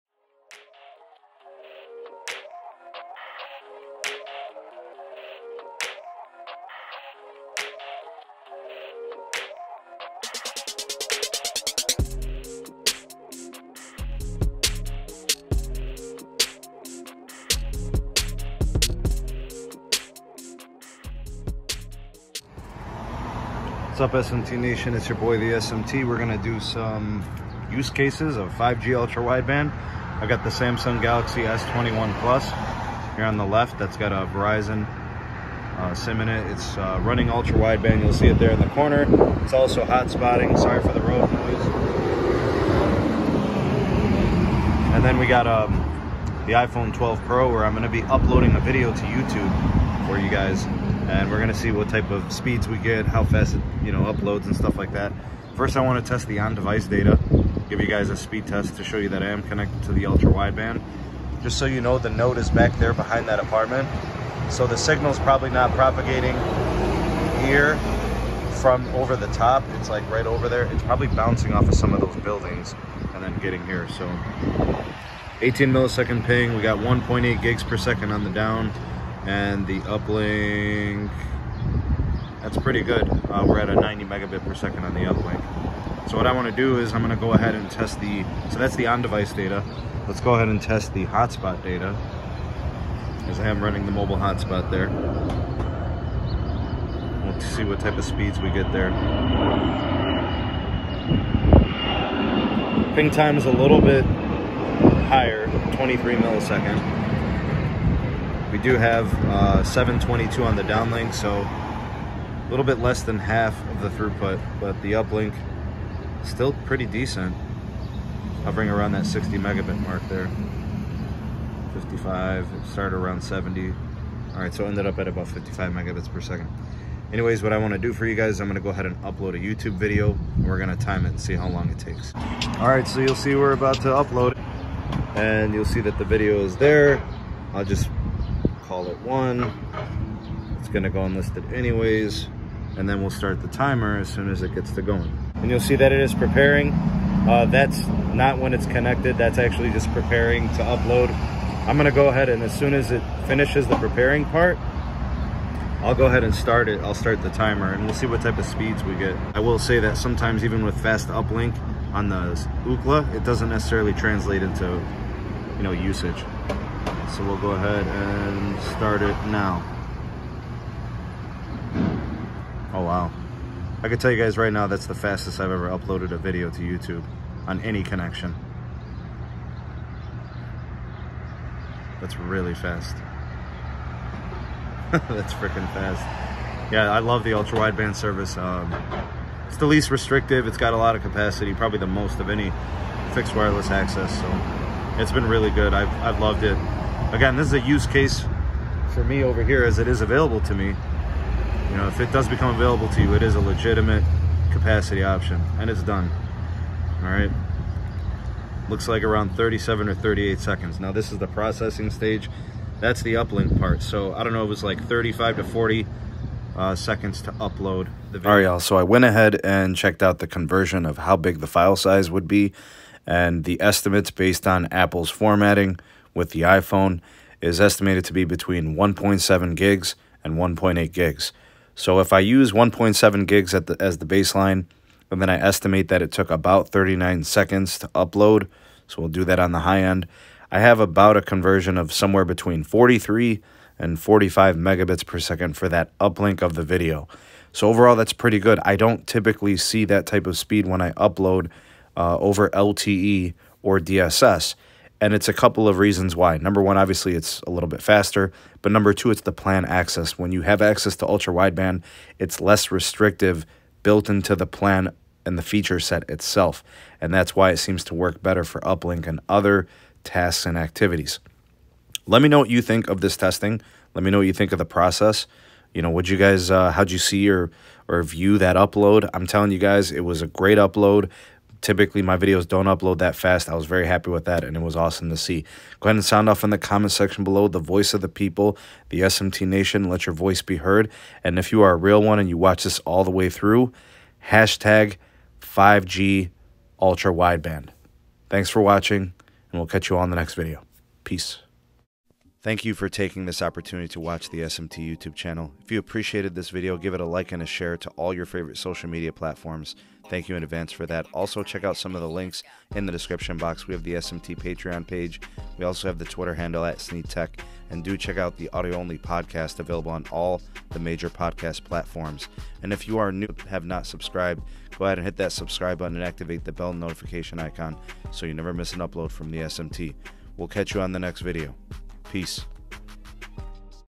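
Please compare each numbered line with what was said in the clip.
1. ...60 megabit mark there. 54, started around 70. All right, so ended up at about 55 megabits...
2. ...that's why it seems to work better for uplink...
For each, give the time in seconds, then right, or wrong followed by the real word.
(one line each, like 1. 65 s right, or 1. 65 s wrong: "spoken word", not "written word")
1. 119 s wrong: "55", not "54"
2. 267 s right.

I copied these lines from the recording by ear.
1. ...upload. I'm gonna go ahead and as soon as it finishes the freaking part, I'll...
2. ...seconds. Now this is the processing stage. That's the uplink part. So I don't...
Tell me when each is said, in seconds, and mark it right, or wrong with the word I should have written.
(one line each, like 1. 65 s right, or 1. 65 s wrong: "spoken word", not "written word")
1. 150 s wrong: "preparing", not "freaking"
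2. 210 s right.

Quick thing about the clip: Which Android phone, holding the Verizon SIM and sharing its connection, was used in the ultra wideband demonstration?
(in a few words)
Samsung Galaxy S21 Plus.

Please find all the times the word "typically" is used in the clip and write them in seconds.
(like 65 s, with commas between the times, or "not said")
249 s, 281 s.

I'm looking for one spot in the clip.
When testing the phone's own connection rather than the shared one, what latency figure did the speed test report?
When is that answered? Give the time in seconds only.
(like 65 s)
75 s.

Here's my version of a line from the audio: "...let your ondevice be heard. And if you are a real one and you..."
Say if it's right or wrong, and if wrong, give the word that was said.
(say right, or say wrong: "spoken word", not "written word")
wrong: "voice", not "ondevice".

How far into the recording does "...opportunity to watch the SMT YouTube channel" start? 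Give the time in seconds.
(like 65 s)
303 s.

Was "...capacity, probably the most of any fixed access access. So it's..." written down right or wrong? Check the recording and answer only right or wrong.
wrong.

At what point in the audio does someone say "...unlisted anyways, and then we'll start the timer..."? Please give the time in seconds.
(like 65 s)
141 s.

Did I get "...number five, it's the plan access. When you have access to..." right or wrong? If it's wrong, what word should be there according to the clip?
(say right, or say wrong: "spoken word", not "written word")
wrong: "two", not "five".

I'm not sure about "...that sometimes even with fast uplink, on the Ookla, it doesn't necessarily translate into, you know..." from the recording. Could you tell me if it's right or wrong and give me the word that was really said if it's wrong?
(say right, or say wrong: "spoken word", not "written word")
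right.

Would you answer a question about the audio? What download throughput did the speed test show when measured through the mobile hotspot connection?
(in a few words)
722.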